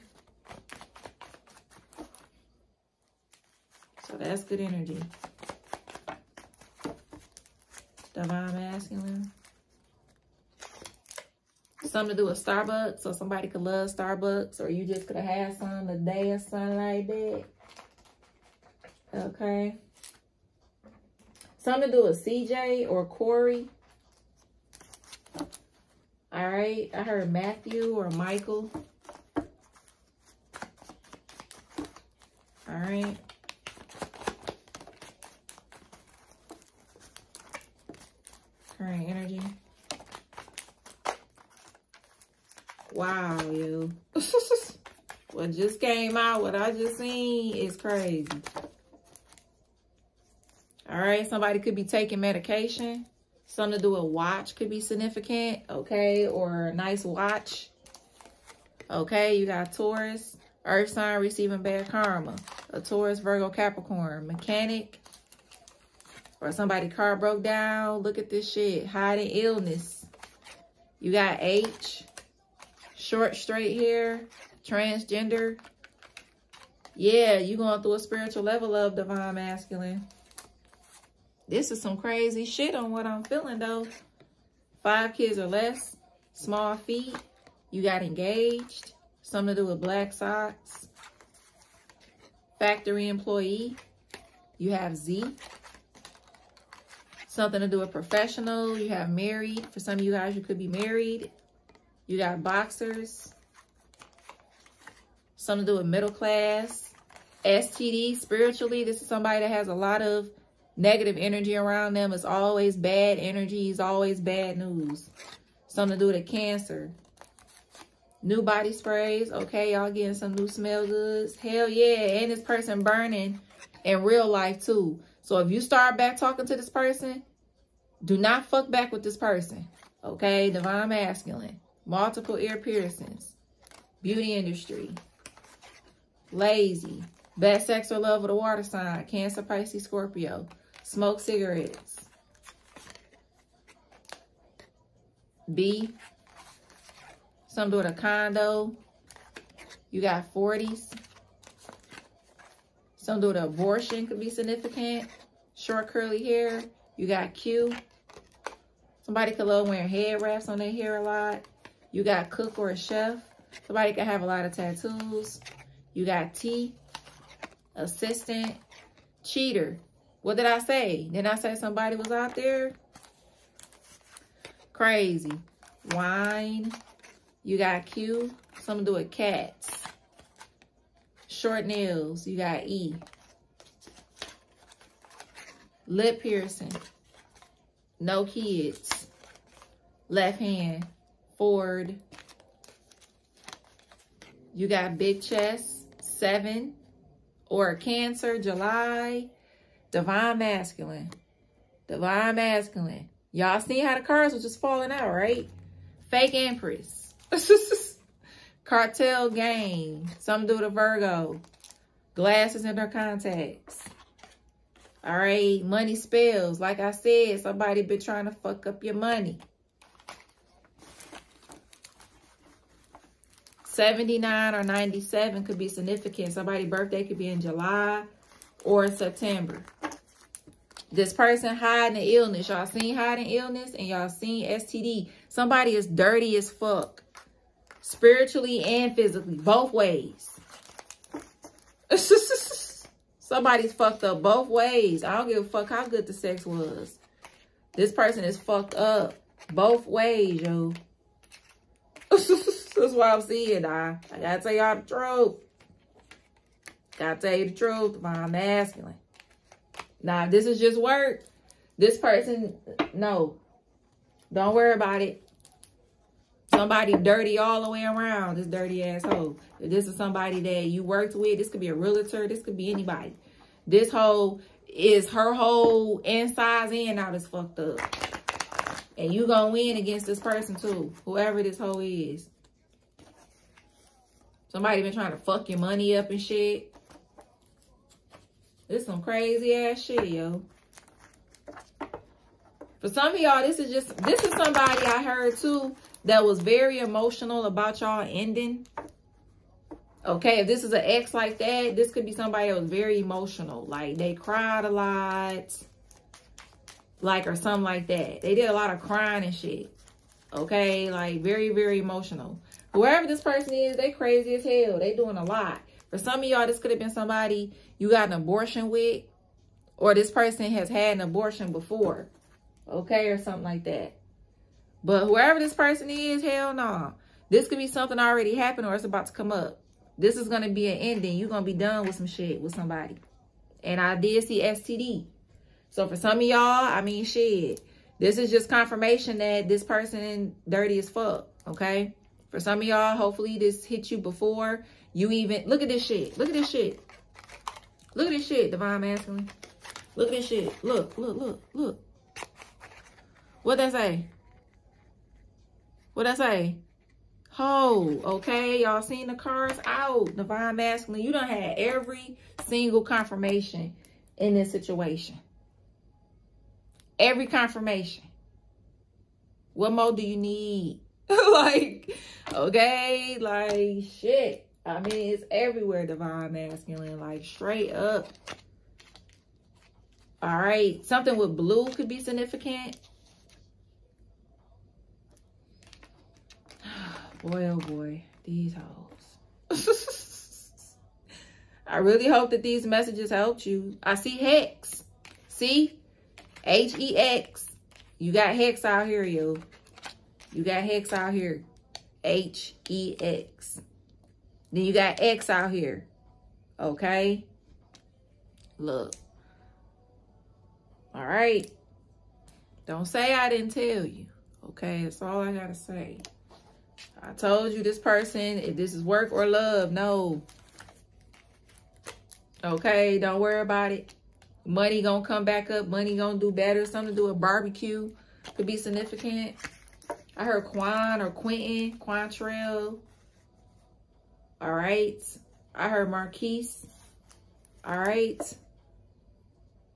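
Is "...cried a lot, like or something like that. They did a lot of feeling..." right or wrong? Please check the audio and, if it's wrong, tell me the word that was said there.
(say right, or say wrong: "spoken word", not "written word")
wrong: "crying", not "feeling".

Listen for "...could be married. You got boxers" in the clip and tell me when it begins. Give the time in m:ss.
1:40.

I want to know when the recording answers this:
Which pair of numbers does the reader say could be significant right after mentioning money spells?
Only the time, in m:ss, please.
3:43.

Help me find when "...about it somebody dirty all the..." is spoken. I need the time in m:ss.
4:24.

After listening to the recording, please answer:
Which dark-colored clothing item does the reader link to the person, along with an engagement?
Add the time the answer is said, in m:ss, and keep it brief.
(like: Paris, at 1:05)
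black socks, at 1:29.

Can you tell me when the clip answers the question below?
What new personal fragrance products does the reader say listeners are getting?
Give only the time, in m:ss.
1:58.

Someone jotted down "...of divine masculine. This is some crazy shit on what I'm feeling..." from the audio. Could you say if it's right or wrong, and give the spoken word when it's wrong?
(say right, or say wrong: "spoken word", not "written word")
right.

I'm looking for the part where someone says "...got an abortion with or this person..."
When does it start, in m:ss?
5:17.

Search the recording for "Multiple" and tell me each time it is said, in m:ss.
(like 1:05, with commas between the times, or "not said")
2:11.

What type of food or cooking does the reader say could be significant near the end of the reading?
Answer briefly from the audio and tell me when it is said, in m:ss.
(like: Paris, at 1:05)
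Barbecue, at 7:07.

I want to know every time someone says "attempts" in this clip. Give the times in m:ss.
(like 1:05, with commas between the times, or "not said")
not said.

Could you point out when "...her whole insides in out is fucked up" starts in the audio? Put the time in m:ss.
4:35.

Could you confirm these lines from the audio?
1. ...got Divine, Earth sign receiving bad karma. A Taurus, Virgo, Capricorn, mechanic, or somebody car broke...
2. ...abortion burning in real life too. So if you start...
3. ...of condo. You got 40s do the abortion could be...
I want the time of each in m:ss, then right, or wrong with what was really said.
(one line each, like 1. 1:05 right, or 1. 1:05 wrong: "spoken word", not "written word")
1. 0:59 wrong: "Taurus", not "Divine"
2. 2:02 wrong: "person", not "abortion"
3. 2:27 right.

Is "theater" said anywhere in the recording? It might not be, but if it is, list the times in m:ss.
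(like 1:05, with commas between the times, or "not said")
not said.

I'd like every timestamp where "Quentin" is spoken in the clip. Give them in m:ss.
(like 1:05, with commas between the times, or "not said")
7:11.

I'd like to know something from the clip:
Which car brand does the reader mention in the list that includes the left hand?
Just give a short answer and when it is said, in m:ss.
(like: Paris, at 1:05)
Ford, at 3:11.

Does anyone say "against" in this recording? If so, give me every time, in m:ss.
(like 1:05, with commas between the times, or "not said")
4:39.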